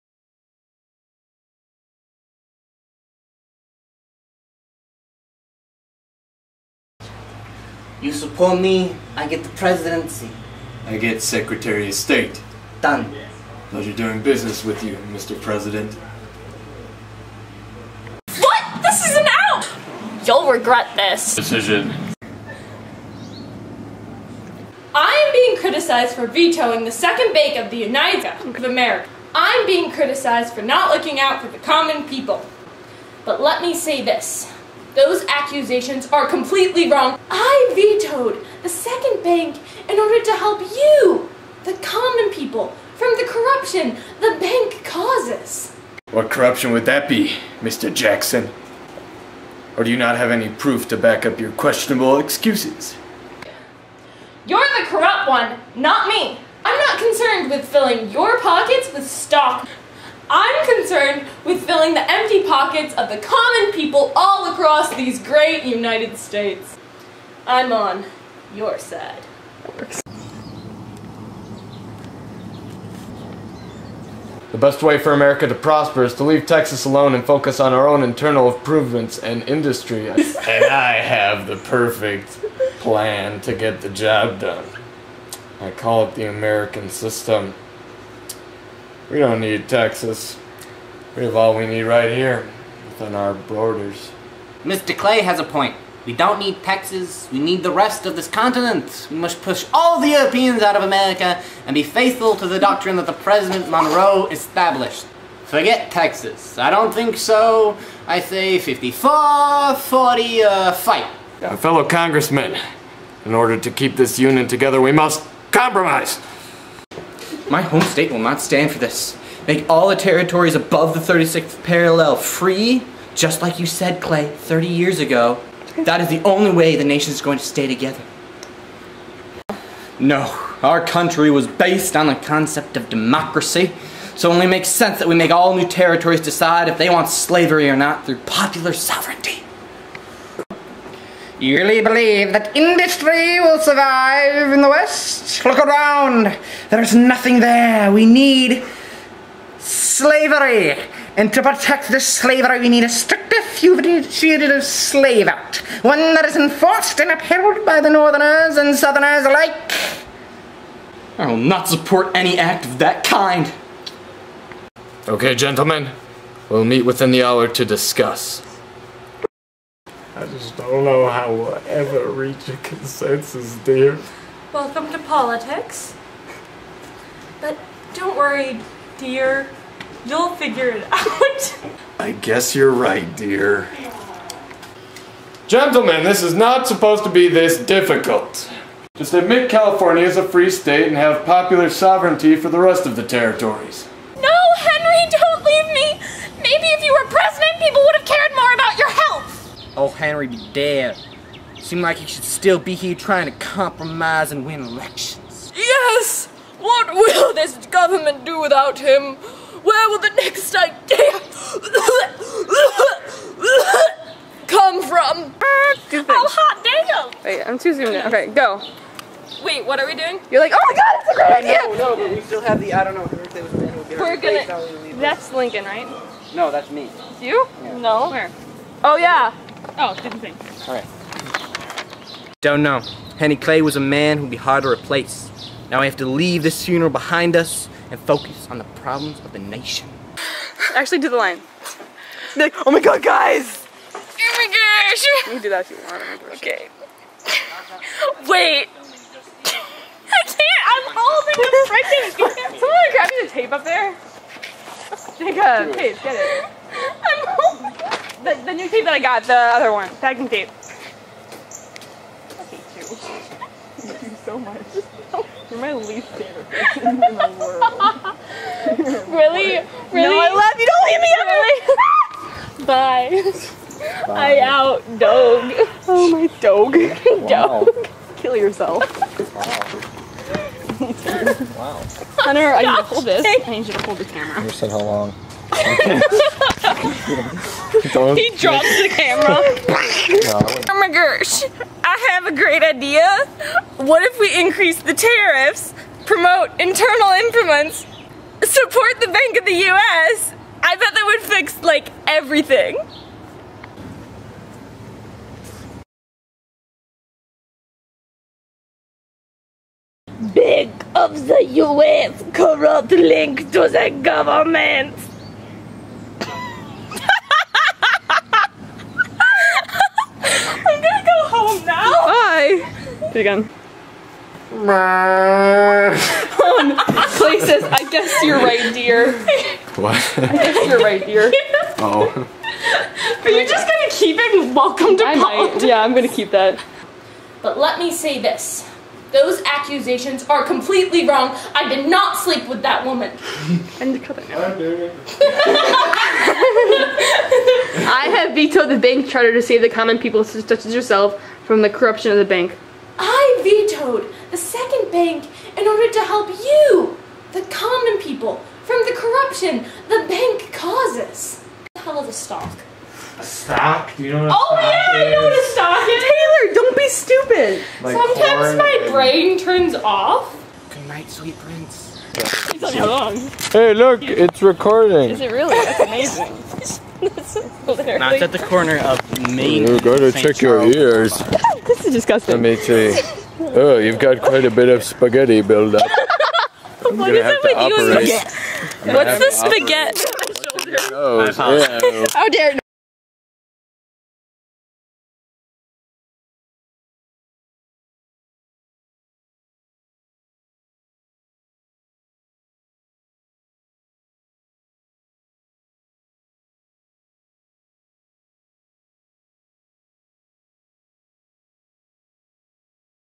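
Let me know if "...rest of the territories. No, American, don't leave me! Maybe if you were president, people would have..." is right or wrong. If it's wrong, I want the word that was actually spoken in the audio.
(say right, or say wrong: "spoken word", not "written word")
wrong: "Henry", not "American".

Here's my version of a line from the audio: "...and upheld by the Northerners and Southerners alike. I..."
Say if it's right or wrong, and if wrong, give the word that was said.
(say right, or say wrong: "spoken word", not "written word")
right.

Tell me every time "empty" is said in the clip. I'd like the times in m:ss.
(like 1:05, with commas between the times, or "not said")
1:02.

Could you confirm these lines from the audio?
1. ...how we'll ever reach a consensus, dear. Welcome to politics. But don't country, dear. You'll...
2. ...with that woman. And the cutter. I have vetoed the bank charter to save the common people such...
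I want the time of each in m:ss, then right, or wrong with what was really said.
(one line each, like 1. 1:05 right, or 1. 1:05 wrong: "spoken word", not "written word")
1. 2:51 wrong: "worry", not "country"
2. 5:42 right.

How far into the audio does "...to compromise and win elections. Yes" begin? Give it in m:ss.
3:23.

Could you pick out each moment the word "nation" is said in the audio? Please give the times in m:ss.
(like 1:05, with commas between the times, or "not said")
2:06, 3:59.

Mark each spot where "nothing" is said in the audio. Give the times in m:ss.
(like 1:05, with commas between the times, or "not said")
2:26.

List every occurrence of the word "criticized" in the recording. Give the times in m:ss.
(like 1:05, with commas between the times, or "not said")
0:25, 0:29.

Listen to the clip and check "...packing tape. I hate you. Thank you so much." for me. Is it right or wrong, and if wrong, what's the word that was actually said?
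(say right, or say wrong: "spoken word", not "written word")
right.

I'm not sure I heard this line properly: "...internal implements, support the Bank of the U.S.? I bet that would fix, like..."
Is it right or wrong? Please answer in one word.
right.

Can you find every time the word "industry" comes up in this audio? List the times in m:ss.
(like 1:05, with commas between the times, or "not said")
1:19, 2:22.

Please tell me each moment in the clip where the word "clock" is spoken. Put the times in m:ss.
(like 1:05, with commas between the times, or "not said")
not said.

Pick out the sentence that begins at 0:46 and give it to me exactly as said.
What corruption would that be, Mr.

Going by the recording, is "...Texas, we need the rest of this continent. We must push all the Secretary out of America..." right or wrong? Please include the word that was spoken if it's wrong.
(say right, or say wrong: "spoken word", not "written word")
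wrong: "Europeans", not "Secretary".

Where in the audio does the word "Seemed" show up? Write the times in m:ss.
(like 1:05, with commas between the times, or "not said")
3:21.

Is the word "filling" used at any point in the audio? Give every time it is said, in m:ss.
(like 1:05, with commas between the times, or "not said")
0:57, 1:01.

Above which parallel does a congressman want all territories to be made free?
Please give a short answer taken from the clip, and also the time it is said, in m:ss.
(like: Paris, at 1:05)
36th parallel, at 2:01.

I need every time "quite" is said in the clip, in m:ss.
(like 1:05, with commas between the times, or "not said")
6:24.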